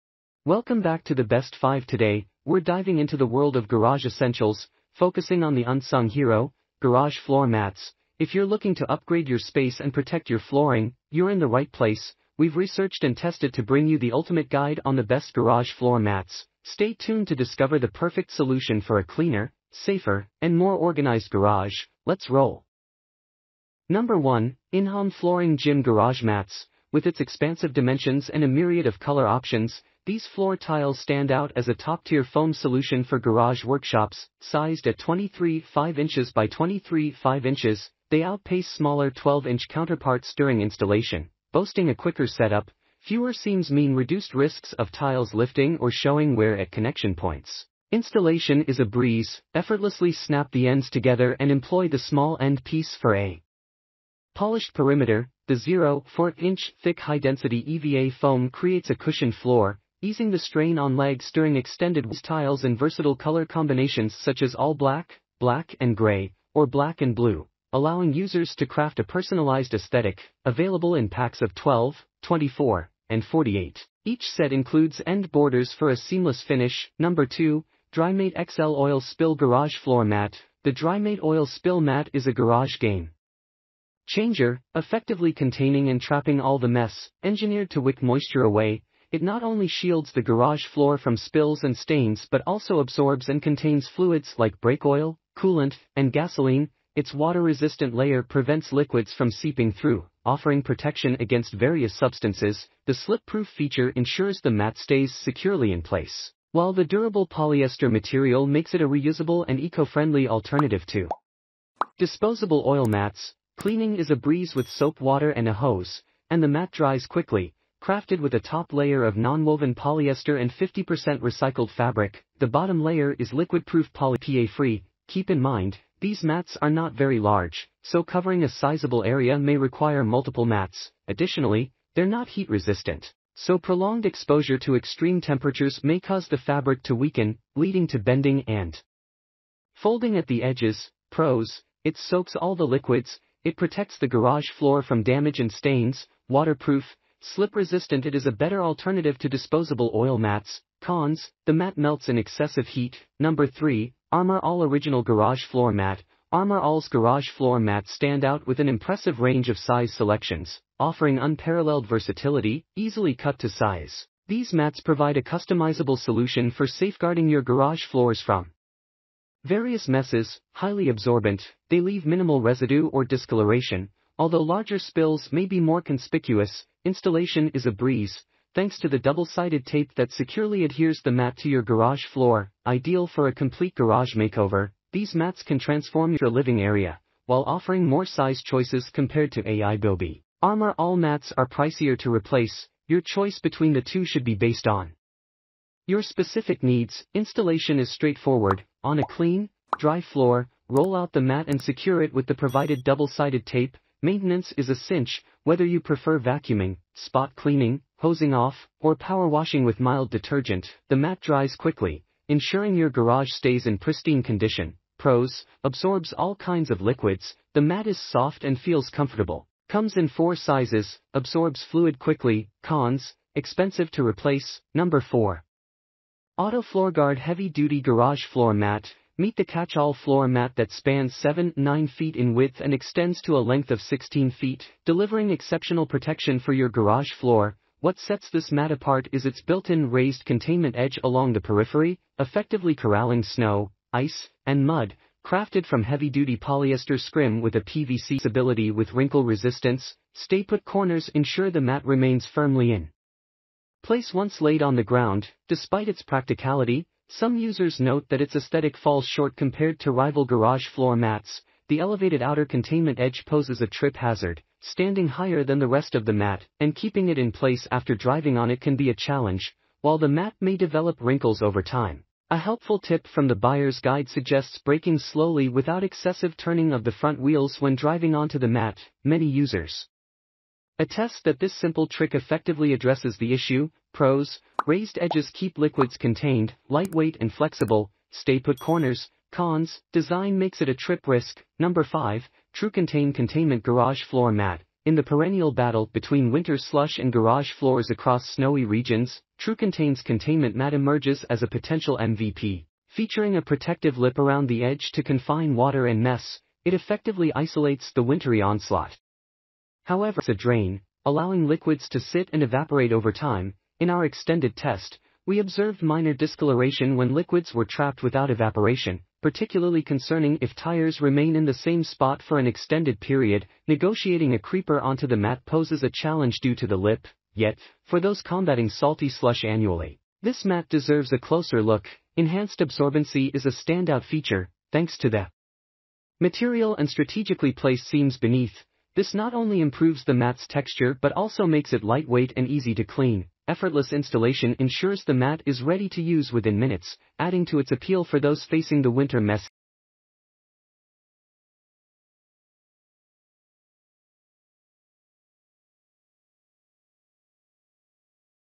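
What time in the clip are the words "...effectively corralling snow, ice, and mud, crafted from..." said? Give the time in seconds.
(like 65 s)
242 s.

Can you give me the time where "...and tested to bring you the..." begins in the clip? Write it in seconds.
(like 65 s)
13 s.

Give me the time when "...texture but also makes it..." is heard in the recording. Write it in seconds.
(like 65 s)
340 s.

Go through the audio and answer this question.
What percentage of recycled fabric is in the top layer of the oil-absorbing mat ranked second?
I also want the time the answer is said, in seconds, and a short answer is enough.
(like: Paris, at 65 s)
50%, at 120 s.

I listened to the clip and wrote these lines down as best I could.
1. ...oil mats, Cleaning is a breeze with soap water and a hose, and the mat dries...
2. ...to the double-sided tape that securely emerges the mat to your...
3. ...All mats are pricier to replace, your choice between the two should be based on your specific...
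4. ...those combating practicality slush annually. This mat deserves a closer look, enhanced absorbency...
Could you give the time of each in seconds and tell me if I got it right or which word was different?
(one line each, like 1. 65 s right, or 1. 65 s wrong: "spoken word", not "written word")
1. 112 s right
2. 178 s wrong: "adheres", not "emerges"
3. 190 s right
4. 327 s wrong: "salty", not "practicality".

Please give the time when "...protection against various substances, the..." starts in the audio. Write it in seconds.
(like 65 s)
100 s.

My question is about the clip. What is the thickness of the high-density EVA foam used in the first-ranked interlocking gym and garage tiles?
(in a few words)
0.4-inch.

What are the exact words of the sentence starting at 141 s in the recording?
Pros, it soaks all the liquids, it protects the garage floor from damage and stains, waterproof, slip resistant.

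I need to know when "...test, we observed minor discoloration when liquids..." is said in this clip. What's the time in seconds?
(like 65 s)
314 s.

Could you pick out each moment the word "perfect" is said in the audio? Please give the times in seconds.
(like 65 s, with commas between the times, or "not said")
17 s.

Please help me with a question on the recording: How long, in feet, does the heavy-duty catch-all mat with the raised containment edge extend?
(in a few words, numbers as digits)
16 feet.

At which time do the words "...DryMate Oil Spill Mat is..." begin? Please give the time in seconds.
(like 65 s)
80 s.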